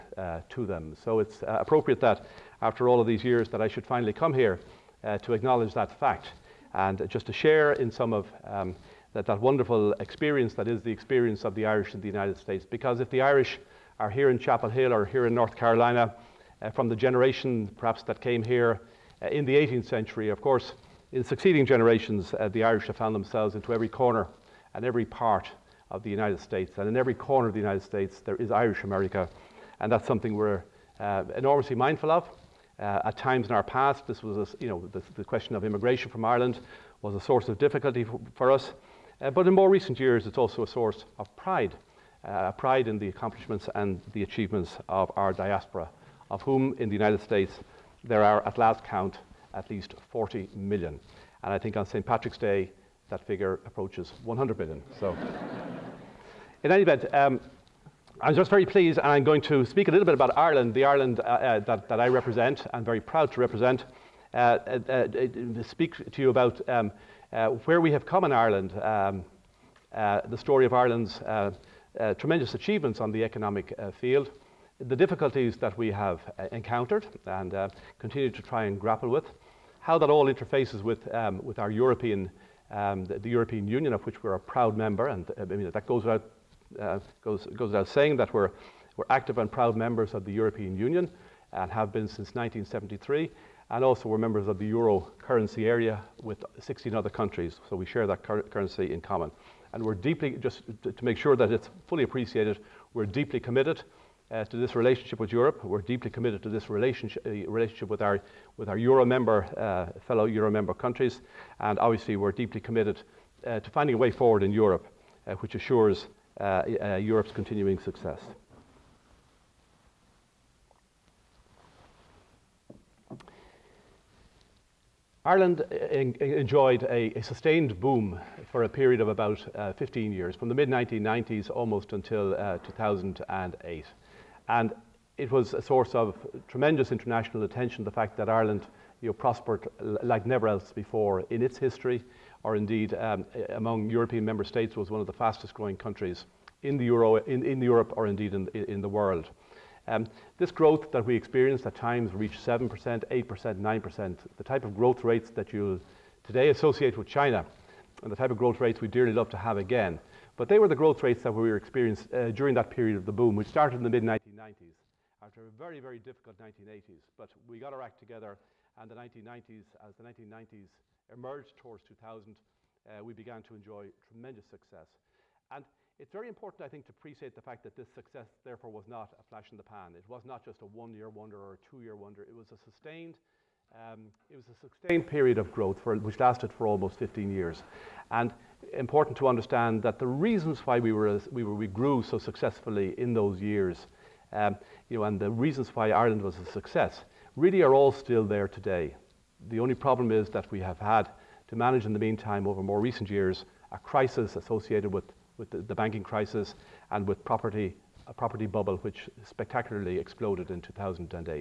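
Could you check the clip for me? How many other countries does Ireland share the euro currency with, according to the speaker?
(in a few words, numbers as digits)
16.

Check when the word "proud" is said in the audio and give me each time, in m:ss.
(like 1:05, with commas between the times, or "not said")
1:03, 1:24, 1:29.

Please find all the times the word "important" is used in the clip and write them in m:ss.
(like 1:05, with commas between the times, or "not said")
2:56, 3:08.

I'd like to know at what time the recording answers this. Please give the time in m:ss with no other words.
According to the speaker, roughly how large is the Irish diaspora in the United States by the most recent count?
0:50.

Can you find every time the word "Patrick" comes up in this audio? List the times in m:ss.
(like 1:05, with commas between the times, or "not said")
0:52.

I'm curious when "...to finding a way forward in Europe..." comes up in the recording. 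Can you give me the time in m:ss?
1:53.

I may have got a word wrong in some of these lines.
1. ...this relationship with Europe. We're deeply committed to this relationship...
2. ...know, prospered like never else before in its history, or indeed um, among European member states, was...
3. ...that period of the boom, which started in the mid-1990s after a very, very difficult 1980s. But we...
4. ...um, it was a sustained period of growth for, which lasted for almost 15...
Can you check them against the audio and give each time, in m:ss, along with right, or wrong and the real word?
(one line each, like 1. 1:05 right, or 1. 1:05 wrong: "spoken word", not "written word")
1. 1:44 right
2. 2:19 right
3. 2:42 right
4. 3:03 right.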